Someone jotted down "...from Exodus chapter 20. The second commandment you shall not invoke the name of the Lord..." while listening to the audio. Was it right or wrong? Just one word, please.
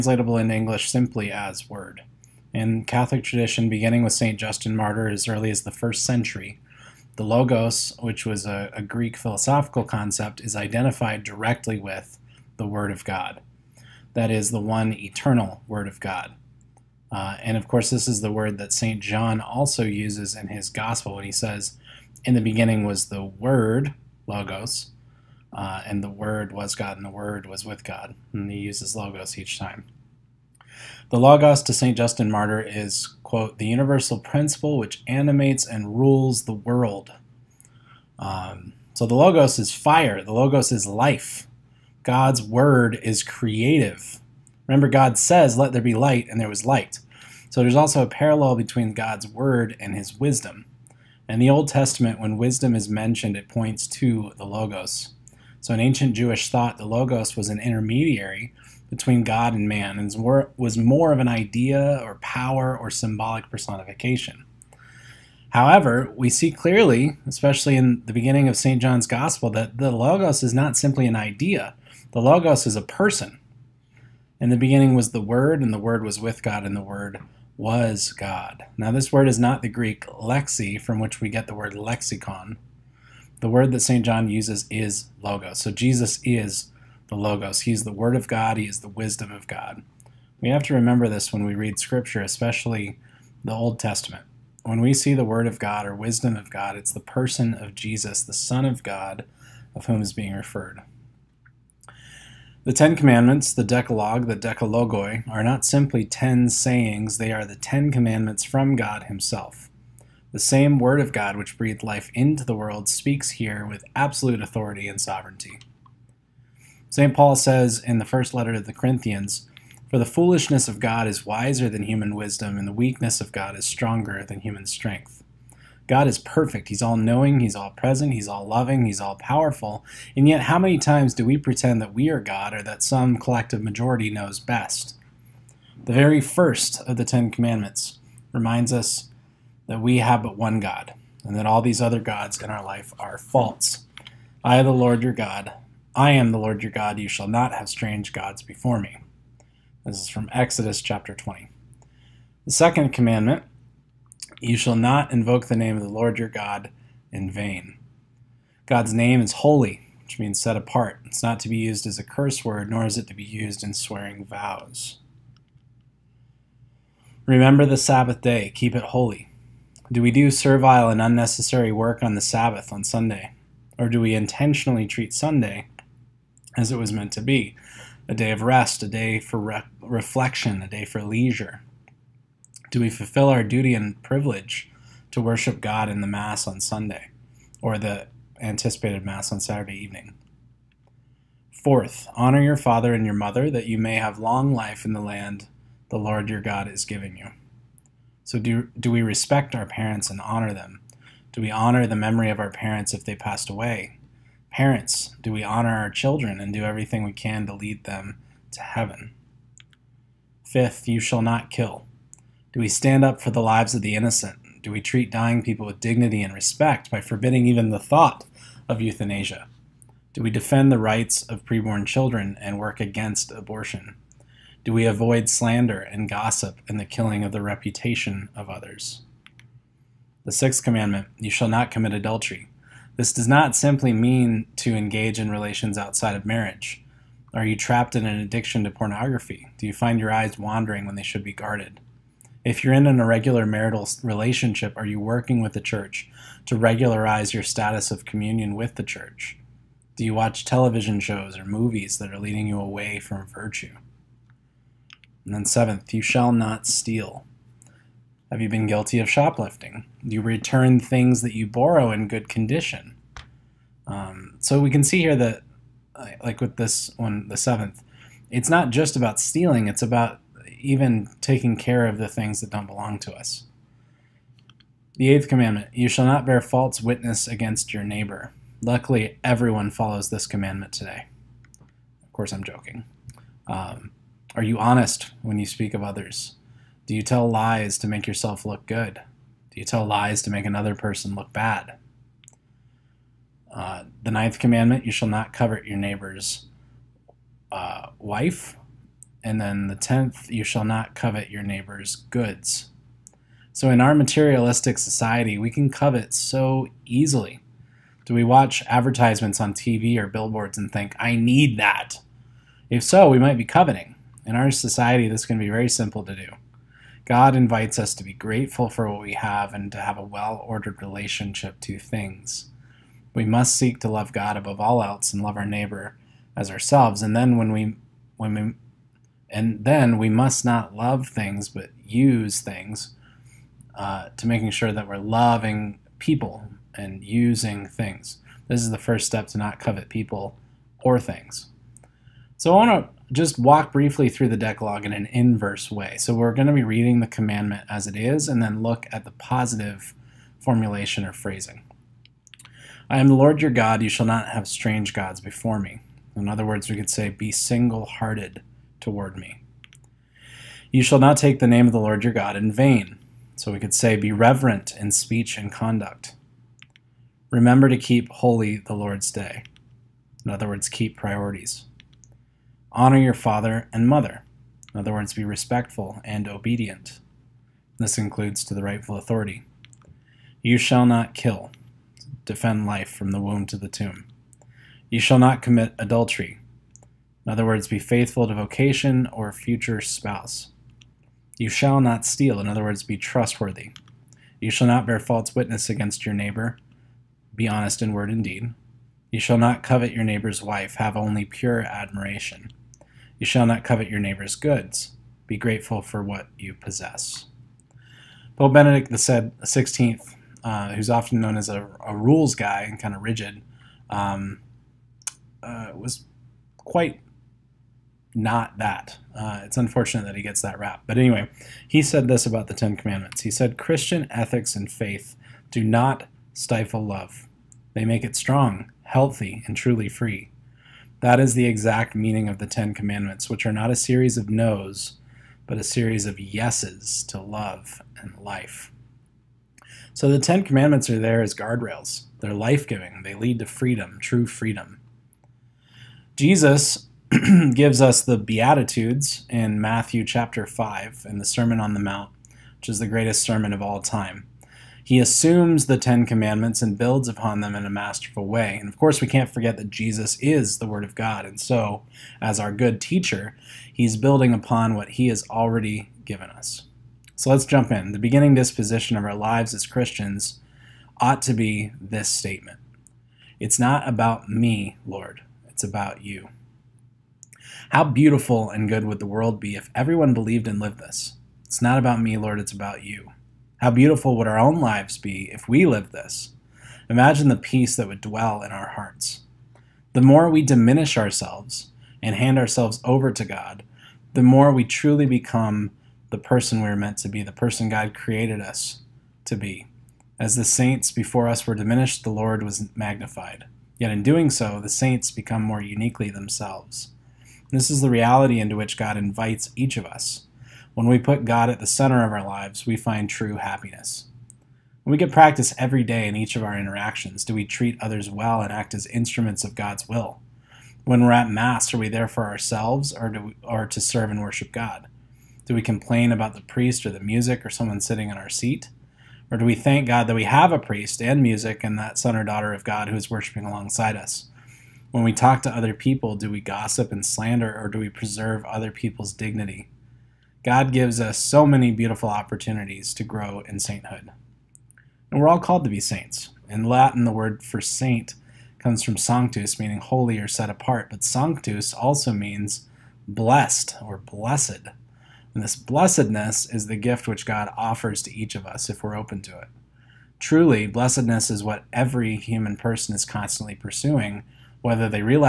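right.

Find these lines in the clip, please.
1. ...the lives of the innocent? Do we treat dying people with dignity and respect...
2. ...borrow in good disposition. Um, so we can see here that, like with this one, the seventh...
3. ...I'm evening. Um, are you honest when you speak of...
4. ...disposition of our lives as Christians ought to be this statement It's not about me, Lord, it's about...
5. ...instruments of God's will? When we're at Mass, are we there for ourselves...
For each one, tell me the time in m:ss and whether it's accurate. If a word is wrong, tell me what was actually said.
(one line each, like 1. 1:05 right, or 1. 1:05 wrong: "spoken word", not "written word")
1. 3:33 right
2. 4:21 wrong: "condition", not "disposition"
3. 4:42 wrong: "joking", not "evening"
4. 7:48 right
5. 8:38 right.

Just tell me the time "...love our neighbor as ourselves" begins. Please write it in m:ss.
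5:25.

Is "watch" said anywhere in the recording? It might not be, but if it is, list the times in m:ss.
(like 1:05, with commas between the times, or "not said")
4:10, 5:08.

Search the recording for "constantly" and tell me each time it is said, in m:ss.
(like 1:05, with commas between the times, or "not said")
9:23.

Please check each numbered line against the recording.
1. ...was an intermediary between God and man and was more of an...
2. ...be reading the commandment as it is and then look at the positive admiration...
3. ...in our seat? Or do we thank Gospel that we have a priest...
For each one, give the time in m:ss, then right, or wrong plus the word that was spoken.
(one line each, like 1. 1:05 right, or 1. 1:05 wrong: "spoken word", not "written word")
1. 0:57 right
2. 5:46 wrong: "formulation", not "admiration"
3. 8:48 wrong: "God", not "Gospel".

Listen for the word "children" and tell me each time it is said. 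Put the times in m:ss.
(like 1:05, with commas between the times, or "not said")
3:25, 3:41.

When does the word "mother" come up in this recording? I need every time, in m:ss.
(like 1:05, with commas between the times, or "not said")
3:13, 6:13.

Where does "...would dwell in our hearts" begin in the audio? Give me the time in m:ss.
8:07.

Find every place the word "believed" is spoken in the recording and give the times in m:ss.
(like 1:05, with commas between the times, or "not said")
8:00.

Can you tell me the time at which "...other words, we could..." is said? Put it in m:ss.
5:56.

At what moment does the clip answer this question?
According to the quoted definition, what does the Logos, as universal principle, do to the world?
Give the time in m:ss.
0:35.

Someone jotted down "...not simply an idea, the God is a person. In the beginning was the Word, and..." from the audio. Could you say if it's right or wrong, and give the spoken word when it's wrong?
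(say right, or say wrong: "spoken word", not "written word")
wrong: "Logos", not "God".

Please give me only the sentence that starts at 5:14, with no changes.
In our society, this can be very simple to do.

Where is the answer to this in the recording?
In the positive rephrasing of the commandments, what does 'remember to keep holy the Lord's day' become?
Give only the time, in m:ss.
6:10.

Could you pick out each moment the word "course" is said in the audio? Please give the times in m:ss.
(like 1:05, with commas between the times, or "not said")
0:17, 4:42, 7:38.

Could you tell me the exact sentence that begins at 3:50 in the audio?
The sixth commandment you shall not commit adultery.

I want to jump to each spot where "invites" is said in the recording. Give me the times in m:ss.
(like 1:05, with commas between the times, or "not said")
5:17, 8:28.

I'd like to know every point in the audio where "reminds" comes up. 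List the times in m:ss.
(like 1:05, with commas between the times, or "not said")
2:18.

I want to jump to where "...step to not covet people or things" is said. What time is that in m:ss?
5:39.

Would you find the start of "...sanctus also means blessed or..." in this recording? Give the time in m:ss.
9:11.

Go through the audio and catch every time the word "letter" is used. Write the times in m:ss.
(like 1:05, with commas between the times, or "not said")
1:58.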